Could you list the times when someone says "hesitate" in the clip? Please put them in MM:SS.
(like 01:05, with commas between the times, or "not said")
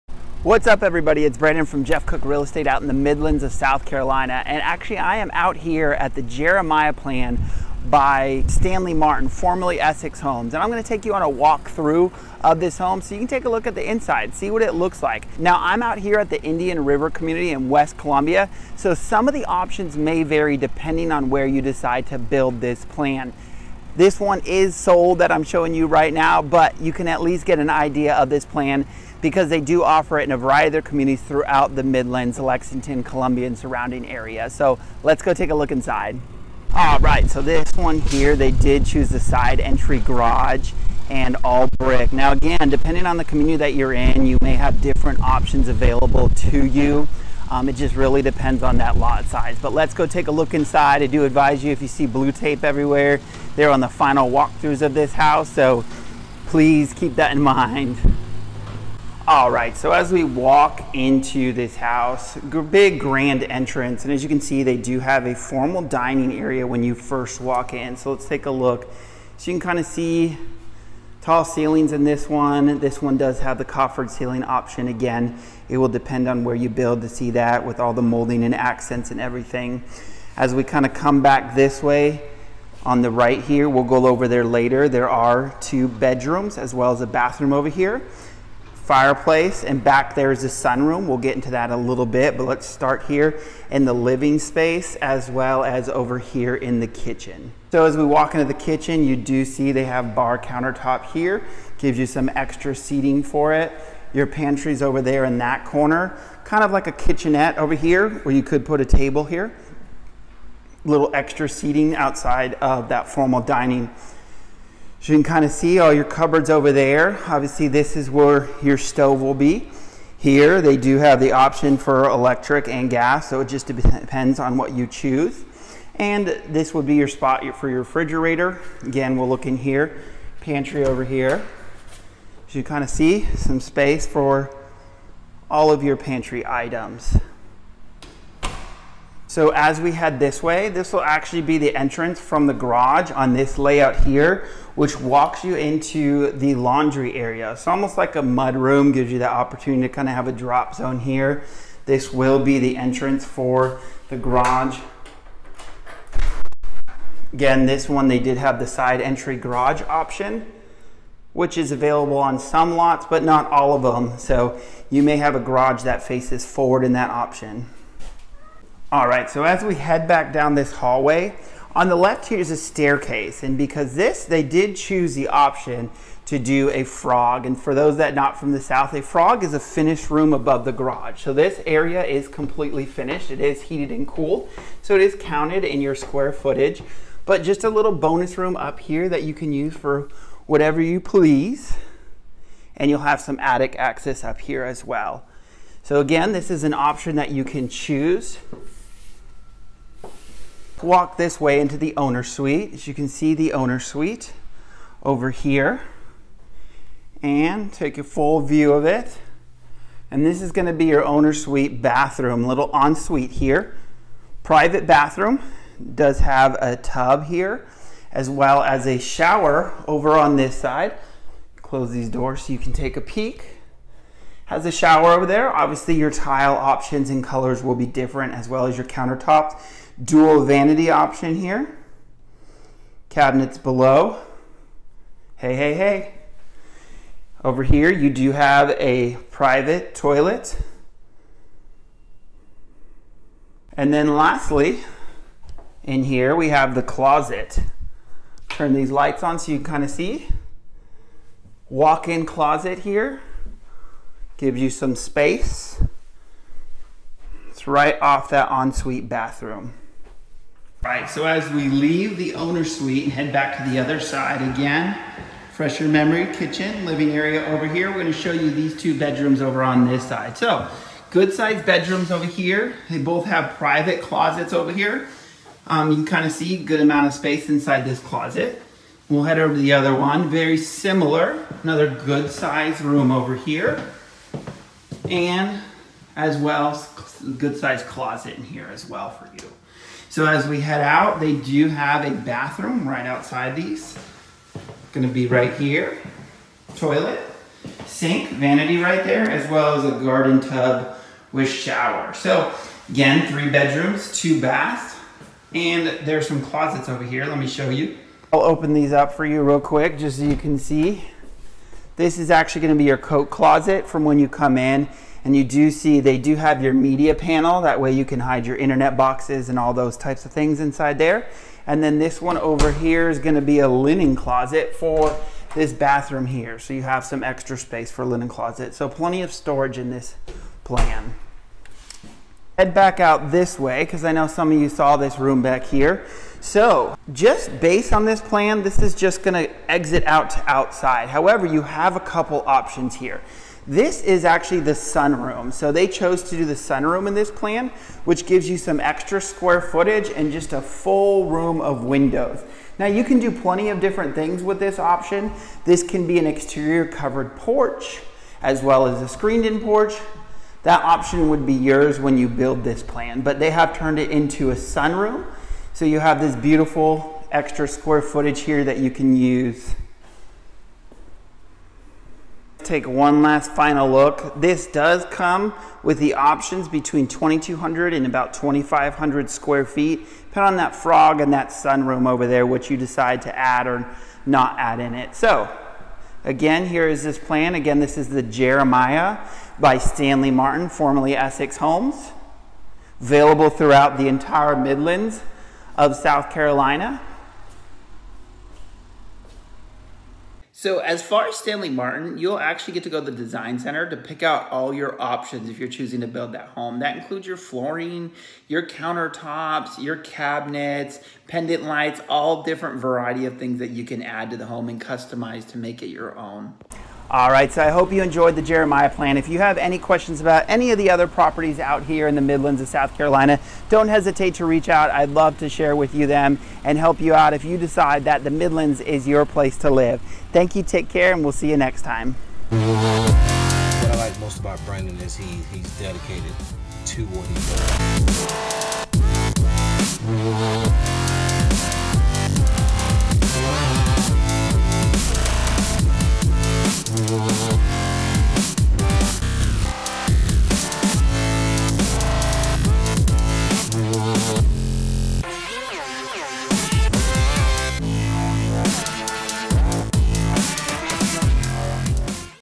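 07:03.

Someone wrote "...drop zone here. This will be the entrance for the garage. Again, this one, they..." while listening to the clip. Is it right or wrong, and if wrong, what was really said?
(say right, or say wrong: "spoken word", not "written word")
right.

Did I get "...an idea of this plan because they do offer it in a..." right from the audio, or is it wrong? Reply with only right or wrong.
right.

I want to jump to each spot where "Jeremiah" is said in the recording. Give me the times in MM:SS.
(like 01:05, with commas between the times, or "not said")
00:06, 06:28, 06:58.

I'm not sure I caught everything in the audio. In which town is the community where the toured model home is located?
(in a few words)
West Columbia.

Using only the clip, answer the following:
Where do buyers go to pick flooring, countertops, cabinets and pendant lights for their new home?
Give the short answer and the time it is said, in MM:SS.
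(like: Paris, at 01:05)
Design center, at 06:43.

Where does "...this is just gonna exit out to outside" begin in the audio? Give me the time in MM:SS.
05:38.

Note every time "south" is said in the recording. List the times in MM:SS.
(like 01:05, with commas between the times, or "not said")
00:03, 02:58, 06:35, 07:02.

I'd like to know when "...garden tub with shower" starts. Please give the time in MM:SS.
05:00.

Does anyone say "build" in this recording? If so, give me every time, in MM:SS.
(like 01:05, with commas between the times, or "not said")
00:22, 01:16, 06:02, 06:46.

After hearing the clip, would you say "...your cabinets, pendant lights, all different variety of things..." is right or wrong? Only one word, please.
right.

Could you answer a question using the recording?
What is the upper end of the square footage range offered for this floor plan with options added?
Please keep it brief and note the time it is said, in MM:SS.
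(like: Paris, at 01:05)
About 2,500 square feet, at 06:18.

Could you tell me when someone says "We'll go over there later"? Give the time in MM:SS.
01:23.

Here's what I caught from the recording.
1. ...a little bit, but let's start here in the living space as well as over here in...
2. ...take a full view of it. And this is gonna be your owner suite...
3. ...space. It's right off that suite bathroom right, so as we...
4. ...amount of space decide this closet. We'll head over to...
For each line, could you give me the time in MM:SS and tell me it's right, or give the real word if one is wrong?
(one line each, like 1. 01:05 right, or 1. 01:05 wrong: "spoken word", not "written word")
1. 01:31 right
2. 03:27 right
3. 04:14 wrong: "ensuite", not "suite"
4. 04:36 wrong: "inside", not "decide".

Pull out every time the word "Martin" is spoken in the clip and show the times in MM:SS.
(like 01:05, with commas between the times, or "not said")
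00:08, 06:30, 06:41.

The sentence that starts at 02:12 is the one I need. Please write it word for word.
So you kind of see some space for all of your pantry items.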